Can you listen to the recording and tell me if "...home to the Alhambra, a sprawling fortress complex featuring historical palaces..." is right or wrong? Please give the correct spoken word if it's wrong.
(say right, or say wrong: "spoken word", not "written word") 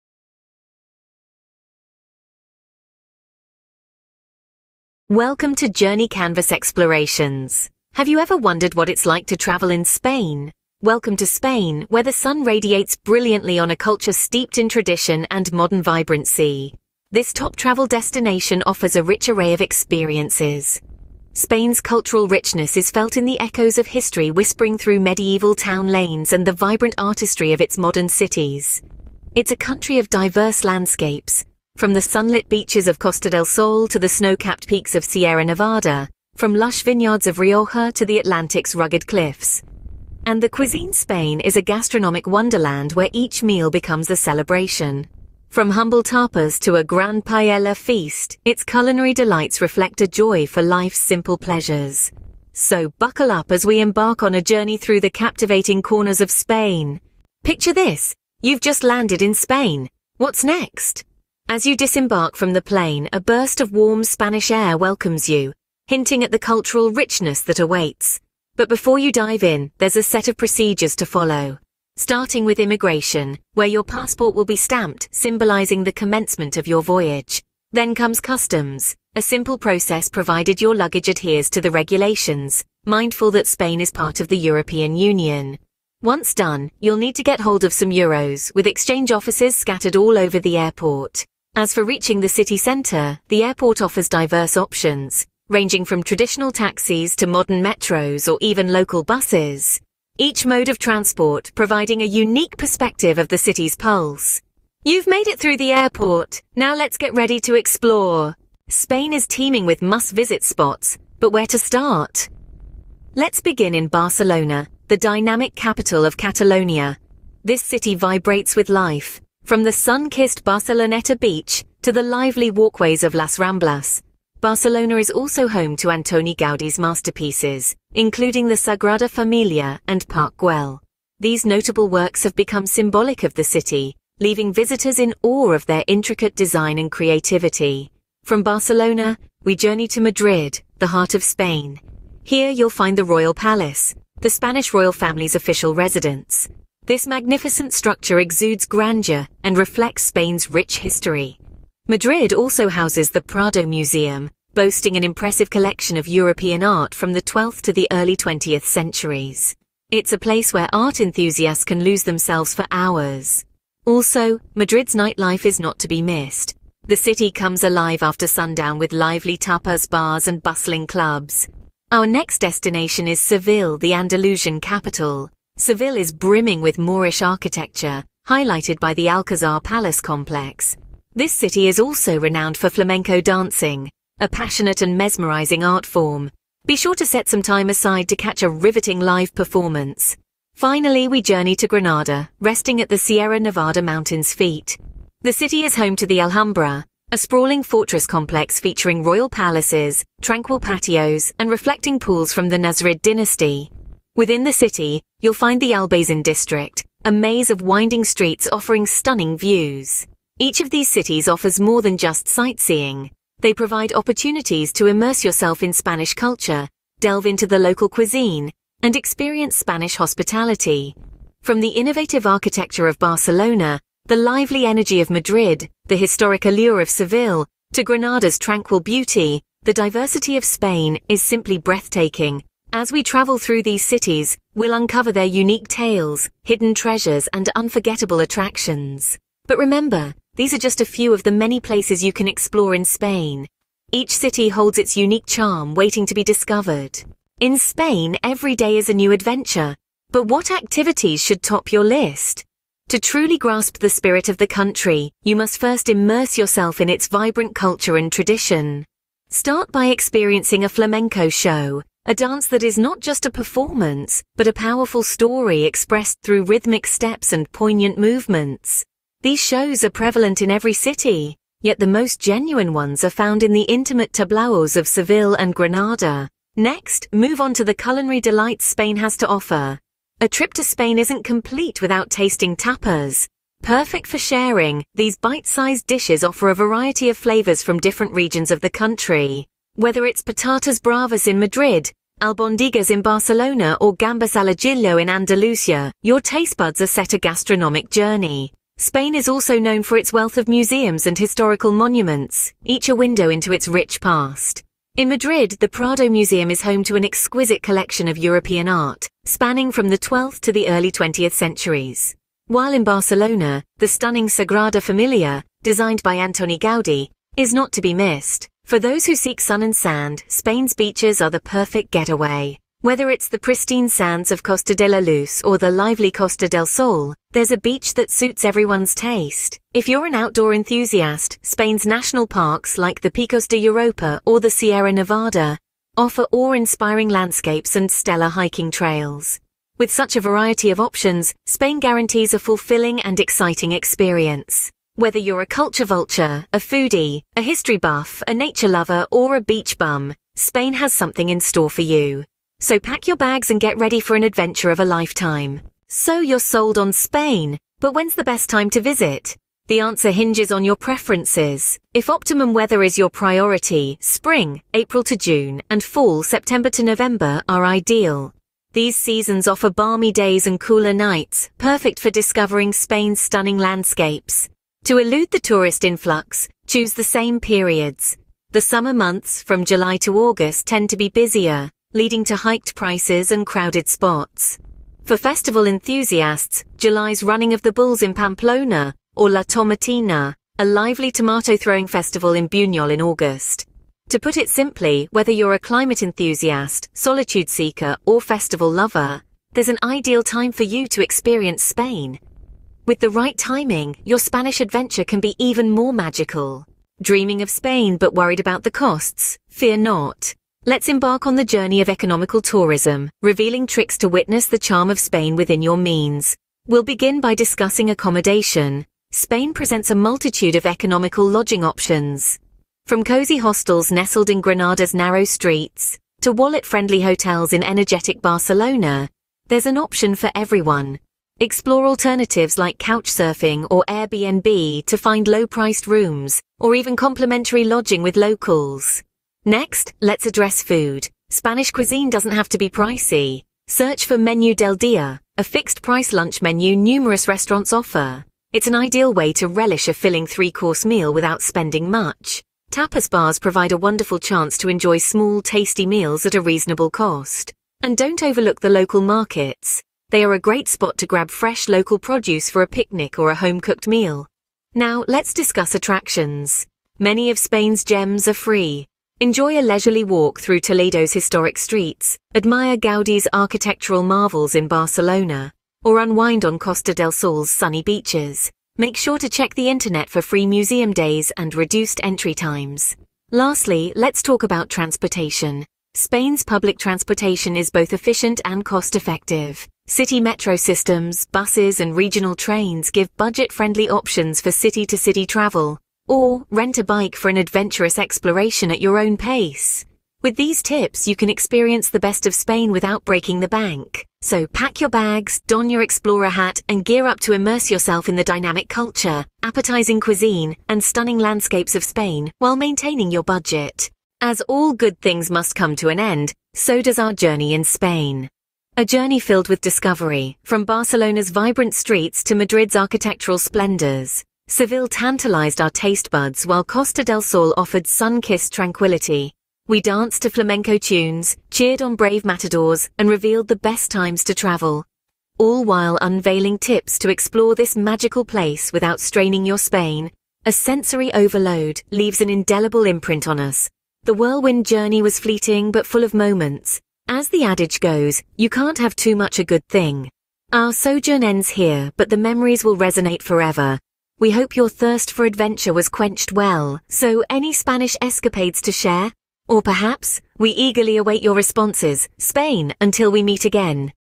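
wrong: "royal", not "historical".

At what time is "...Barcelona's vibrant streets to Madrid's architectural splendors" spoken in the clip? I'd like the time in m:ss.
8:40.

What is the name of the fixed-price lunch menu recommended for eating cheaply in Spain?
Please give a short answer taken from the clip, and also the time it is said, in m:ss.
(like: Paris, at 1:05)
Menu del Dia, at 7:24.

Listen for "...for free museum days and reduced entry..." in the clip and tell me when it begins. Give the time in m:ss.
8:00.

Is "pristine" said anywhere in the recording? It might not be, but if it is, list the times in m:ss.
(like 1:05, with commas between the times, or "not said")
5:23.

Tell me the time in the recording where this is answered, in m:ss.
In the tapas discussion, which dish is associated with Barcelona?
4:52.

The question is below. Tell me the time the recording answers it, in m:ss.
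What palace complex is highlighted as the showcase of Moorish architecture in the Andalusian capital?
2:59.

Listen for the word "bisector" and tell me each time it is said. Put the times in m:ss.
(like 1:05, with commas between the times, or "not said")
not said.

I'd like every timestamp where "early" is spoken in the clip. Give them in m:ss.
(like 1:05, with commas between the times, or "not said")
2:37, 5:10.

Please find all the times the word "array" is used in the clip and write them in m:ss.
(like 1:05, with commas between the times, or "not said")
0:19.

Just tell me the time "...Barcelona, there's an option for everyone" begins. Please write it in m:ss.
7:08.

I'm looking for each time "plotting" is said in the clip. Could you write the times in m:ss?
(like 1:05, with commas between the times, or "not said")
not said.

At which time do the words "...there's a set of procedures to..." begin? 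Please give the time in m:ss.
1:09.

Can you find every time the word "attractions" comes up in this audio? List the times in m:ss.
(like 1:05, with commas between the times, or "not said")
3:58, 7:45.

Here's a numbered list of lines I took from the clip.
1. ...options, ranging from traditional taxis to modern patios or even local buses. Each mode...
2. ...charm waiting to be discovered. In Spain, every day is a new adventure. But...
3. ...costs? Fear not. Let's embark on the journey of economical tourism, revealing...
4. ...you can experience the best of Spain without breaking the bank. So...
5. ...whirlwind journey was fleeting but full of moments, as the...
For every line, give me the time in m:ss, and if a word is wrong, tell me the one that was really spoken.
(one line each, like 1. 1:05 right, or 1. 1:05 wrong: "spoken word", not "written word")
1. 1:34 wrong: "metros", not "patios"
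2. 4:05 right
3. 6:48 right
4. 8:21 right
5. 9:04 right.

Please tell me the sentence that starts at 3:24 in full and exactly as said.
Within the city, you'll find the Albazin district, a maze of winding streets offering stunning views.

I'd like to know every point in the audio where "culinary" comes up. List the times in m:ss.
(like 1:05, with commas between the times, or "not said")
0:48, 4:37.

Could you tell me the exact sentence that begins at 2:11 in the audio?
These notable works have become symbolic of the city, leaving visitors in awe of their intricate design and creativity.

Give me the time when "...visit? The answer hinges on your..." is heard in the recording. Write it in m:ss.
5:58.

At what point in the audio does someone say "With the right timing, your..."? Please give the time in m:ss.
6:42.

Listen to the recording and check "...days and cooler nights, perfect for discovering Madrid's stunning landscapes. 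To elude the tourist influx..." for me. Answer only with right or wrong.
wrong.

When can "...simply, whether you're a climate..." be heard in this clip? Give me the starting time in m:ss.
6:34.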